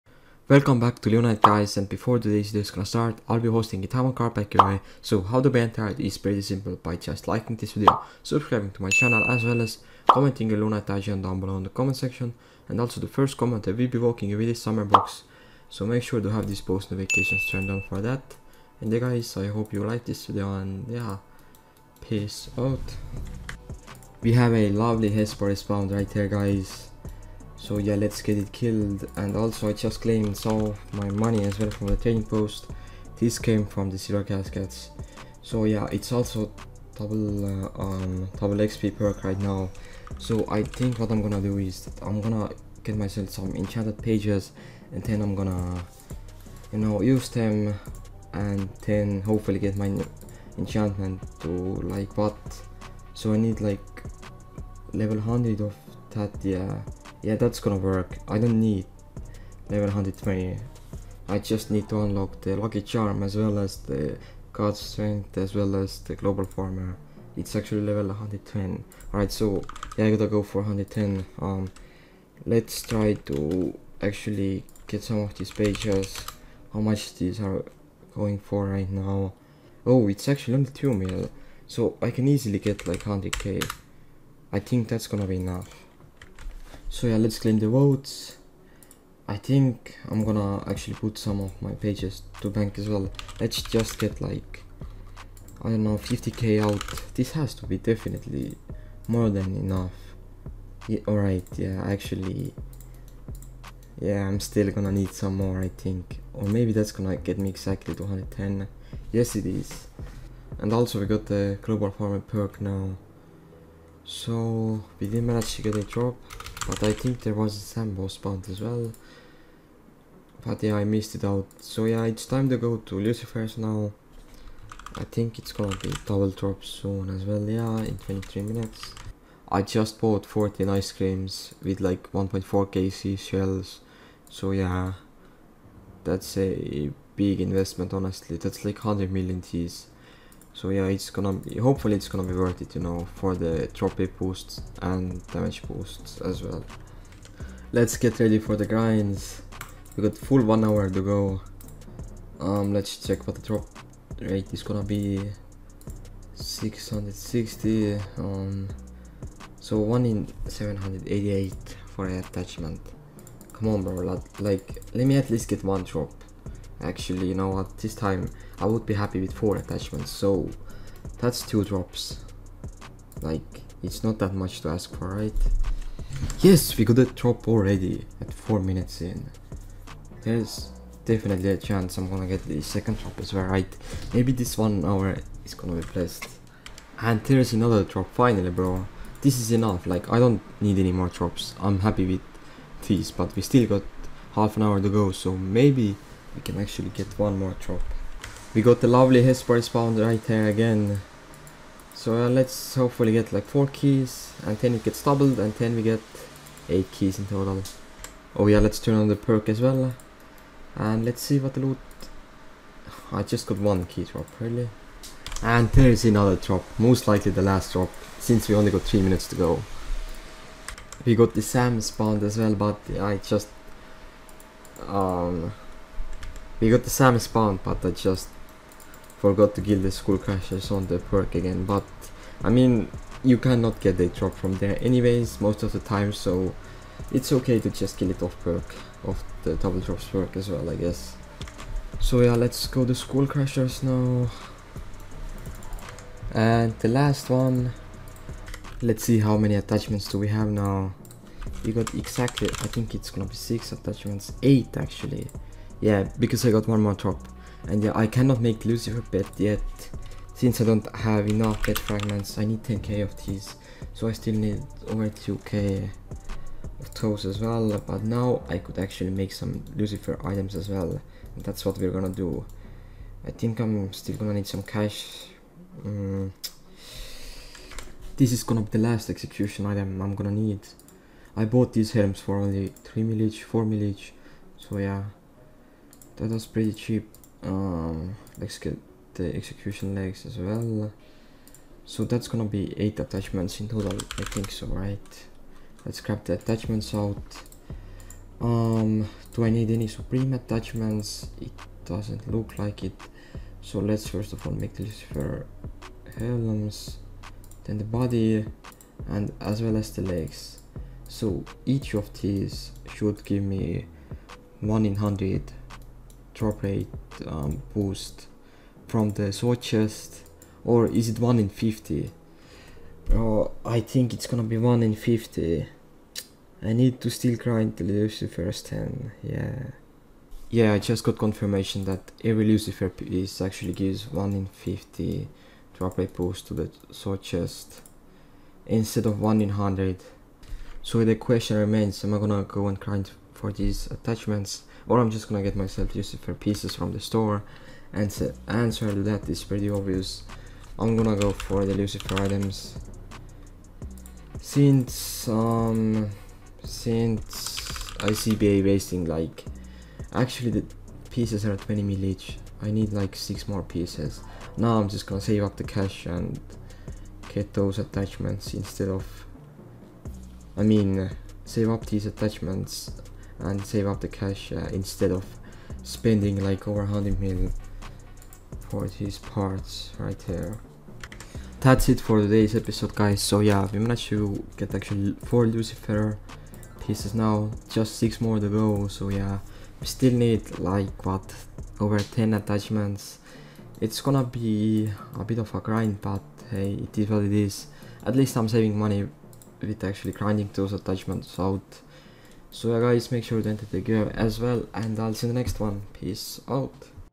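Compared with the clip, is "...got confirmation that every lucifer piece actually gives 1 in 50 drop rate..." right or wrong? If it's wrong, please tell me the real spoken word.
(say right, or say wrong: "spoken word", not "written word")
right.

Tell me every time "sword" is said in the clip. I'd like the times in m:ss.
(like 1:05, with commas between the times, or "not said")
5:19, 5:36.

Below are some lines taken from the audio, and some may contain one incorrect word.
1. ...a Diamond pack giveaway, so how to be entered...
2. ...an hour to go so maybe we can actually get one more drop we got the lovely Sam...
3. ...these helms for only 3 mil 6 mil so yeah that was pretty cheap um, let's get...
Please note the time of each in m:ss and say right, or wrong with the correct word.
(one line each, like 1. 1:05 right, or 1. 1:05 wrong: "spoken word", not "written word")
1. 0:03 right
2. 3:14 wrong: "Hesper", not "Sam"
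3. 4:41 wrong: "4", not "6".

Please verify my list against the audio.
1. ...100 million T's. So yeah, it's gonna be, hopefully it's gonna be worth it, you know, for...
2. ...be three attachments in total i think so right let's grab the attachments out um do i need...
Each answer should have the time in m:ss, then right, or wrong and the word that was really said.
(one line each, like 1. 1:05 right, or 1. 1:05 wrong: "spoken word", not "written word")
1. 2:18 right
2. 4:52 wrong: "eight", not "three".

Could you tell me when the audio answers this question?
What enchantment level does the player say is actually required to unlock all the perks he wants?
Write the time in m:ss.
1:07.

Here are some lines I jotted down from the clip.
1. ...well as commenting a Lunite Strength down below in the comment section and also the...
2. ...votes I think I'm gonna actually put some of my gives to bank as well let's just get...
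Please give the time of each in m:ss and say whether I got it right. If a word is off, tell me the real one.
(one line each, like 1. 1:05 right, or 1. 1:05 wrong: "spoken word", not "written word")
1. 0:09 wrong: "IGN", not "Strength"
2. 1:27 wrong: "pages", not "gives".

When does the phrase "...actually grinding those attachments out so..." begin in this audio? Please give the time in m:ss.
6:39.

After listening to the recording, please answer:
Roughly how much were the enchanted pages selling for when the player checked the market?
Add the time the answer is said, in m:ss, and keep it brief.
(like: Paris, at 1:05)
2 mil, at 1:20.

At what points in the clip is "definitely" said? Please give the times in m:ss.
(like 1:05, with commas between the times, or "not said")
1:37, 3:01.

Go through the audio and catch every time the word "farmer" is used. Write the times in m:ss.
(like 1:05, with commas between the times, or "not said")
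1:06, 1:51.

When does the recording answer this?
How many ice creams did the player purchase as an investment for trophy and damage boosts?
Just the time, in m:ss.
2:10.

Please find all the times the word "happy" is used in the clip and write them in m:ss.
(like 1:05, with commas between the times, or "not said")
2:48, 3:11.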